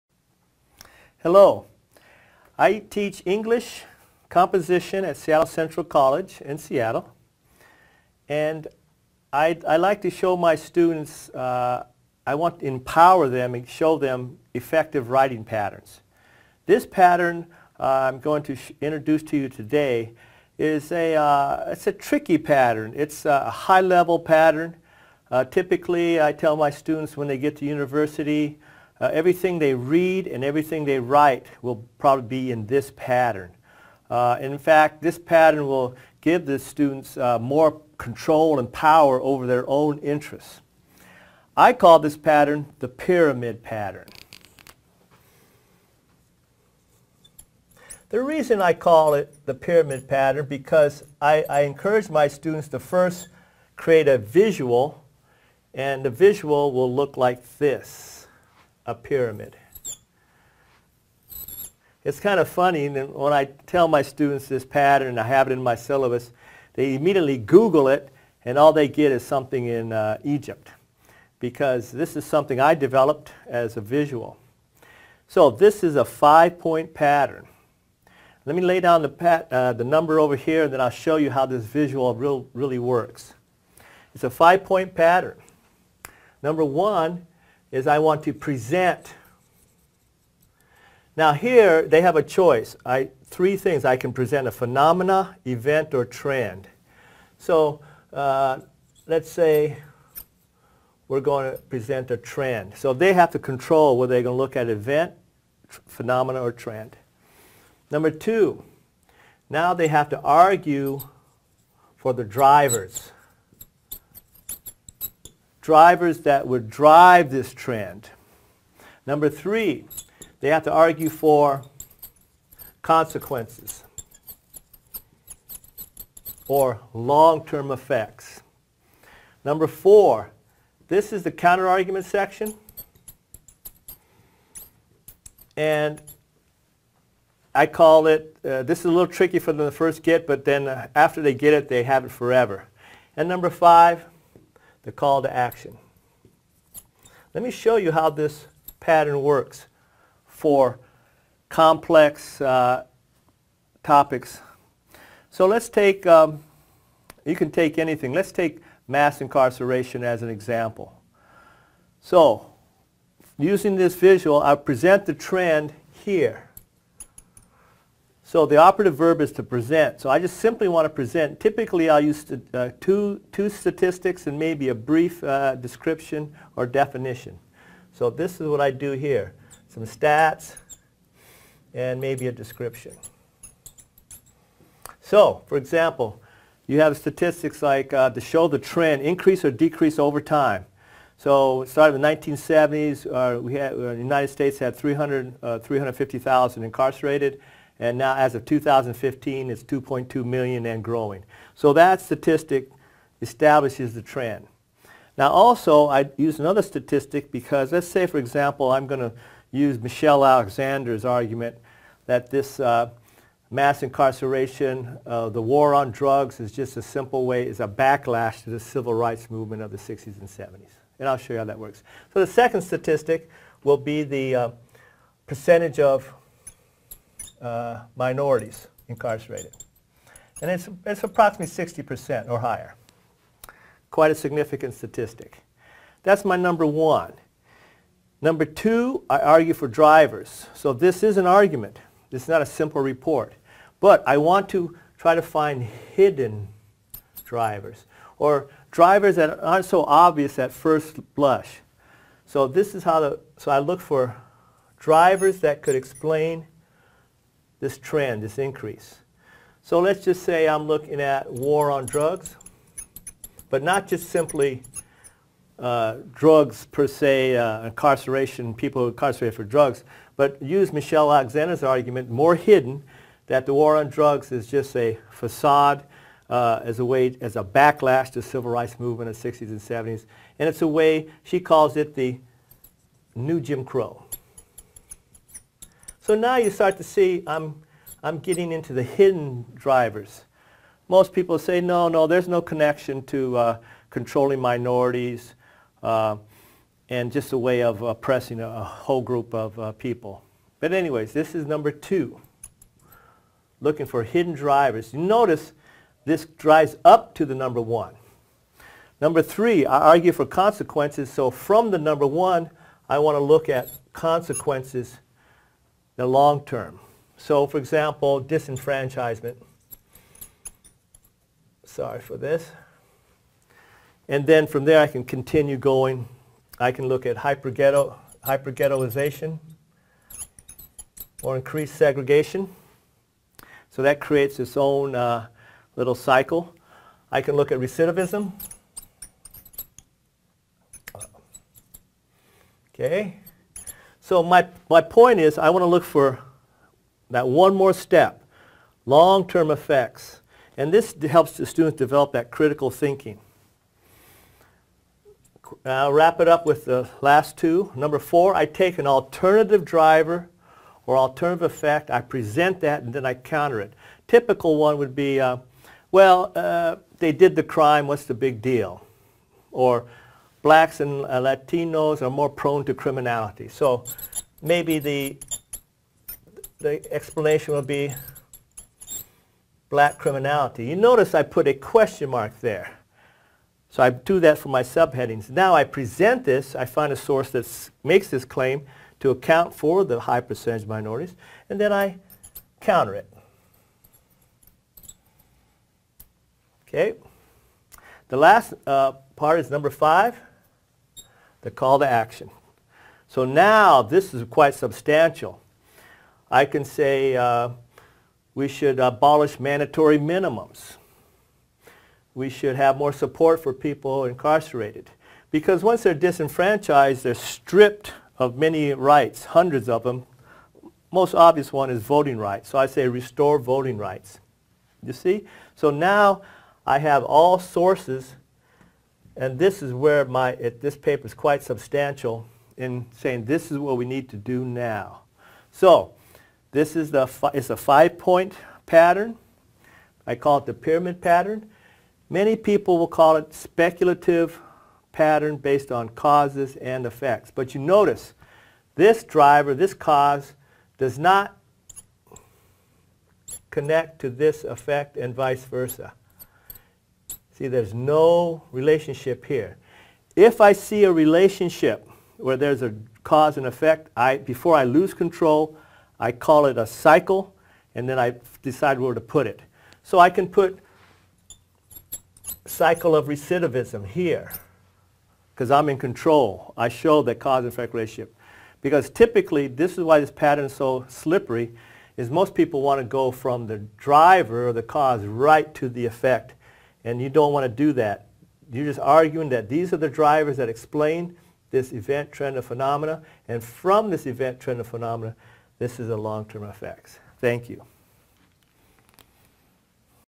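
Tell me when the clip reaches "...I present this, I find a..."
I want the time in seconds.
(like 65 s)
385 s.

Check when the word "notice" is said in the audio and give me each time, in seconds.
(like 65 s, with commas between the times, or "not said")
304 s, 380 s, 447 s.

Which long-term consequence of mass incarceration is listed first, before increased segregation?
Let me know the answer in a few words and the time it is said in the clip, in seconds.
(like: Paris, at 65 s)
disenfranchisement, at 318 s.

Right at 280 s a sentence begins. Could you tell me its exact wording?
And it's a way, she calls it the new Jim Crow.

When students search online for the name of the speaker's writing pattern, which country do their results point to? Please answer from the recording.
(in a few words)
Egypt.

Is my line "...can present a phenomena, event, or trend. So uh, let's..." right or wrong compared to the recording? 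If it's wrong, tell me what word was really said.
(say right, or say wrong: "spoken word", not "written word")
right.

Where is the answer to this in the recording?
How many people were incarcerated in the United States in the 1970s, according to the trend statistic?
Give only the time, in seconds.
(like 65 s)
195 s.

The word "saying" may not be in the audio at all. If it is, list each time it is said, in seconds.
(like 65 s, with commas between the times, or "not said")
432 s.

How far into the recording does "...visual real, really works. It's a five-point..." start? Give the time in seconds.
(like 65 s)
81 s.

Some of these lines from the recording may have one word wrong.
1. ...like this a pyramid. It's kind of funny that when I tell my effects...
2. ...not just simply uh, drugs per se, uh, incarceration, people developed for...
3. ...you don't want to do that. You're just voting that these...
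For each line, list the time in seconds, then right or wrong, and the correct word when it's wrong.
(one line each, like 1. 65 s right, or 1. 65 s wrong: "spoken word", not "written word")
1. 57 s wrong: "students", not "effects"
2. 263 s wrong: "incarcerated", not "developed"
3. 487 s wrong: "arguing", not "voting".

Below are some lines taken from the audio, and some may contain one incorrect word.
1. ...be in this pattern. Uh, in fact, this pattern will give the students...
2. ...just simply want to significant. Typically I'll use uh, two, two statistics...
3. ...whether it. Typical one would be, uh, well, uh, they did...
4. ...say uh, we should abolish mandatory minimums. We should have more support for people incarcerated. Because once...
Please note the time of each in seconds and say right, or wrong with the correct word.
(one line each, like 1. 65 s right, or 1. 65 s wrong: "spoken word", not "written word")
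1. 32 s right
2. 170 s wrong: "present", not "significant"
3. 363 s wrong: "counter", not "whether"
4. 406 s right.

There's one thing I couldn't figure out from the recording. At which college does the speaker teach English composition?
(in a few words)
Seattle Central College.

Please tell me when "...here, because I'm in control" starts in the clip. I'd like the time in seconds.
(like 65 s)
473 s.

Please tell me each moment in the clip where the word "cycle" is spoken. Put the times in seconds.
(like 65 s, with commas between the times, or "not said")
335 s, 466 s, 472 s.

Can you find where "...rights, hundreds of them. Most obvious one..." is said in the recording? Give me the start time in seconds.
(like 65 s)
418 s.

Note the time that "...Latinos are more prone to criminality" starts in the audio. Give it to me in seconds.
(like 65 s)
371 s.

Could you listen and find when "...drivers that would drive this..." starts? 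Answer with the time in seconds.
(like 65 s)
115 s.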